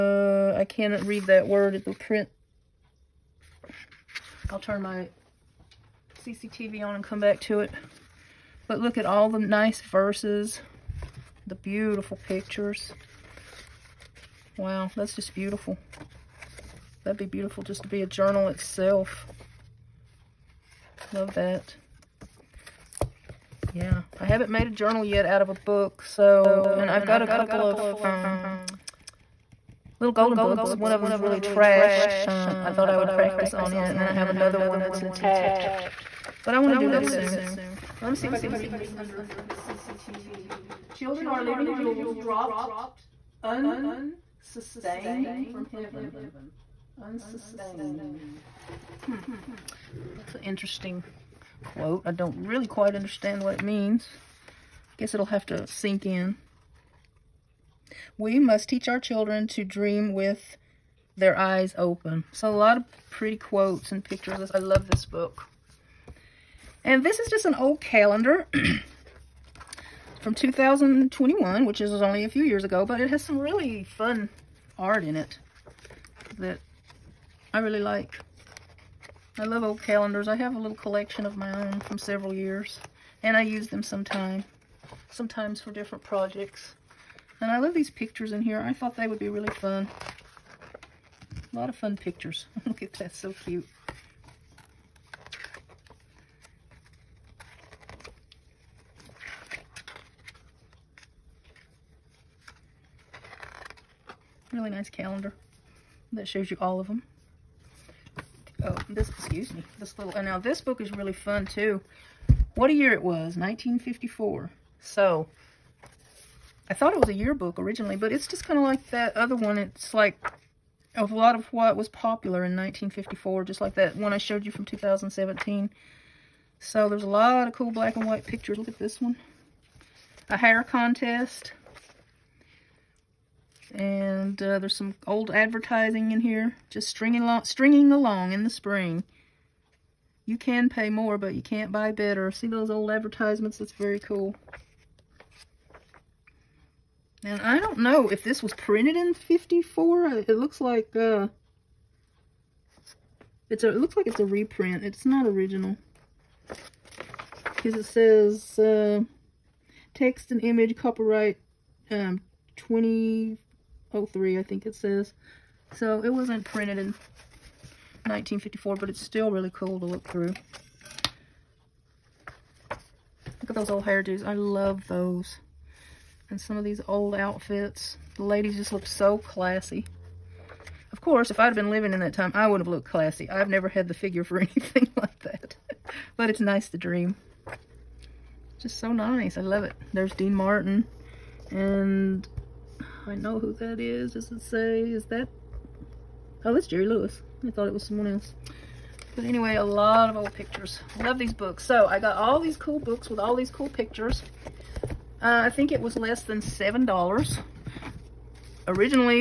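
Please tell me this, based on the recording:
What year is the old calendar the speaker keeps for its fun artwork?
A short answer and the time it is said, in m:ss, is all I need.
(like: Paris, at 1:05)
2021, at 1:10.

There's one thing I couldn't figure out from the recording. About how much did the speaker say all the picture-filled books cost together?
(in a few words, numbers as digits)
less than $7.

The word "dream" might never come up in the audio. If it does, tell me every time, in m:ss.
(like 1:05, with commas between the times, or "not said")
0:59, 3:06.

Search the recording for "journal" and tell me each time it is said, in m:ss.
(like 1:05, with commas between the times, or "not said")
0:18, 0:24.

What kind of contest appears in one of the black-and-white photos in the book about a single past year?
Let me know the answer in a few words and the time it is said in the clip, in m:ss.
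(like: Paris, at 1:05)
hair contest, at 2:10.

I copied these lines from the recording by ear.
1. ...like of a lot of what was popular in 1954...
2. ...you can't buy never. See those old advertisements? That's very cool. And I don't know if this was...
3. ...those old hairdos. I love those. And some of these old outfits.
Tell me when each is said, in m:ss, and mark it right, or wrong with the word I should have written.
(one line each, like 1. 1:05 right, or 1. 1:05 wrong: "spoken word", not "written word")
1. 1:59 right
2. 2:21 wrong: "better", not "never"
3. 2:53 right.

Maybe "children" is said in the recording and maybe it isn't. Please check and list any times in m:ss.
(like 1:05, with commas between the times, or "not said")
0:40, 0:58.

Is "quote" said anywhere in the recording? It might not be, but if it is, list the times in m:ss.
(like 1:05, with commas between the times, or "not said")
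0:51, 1:03.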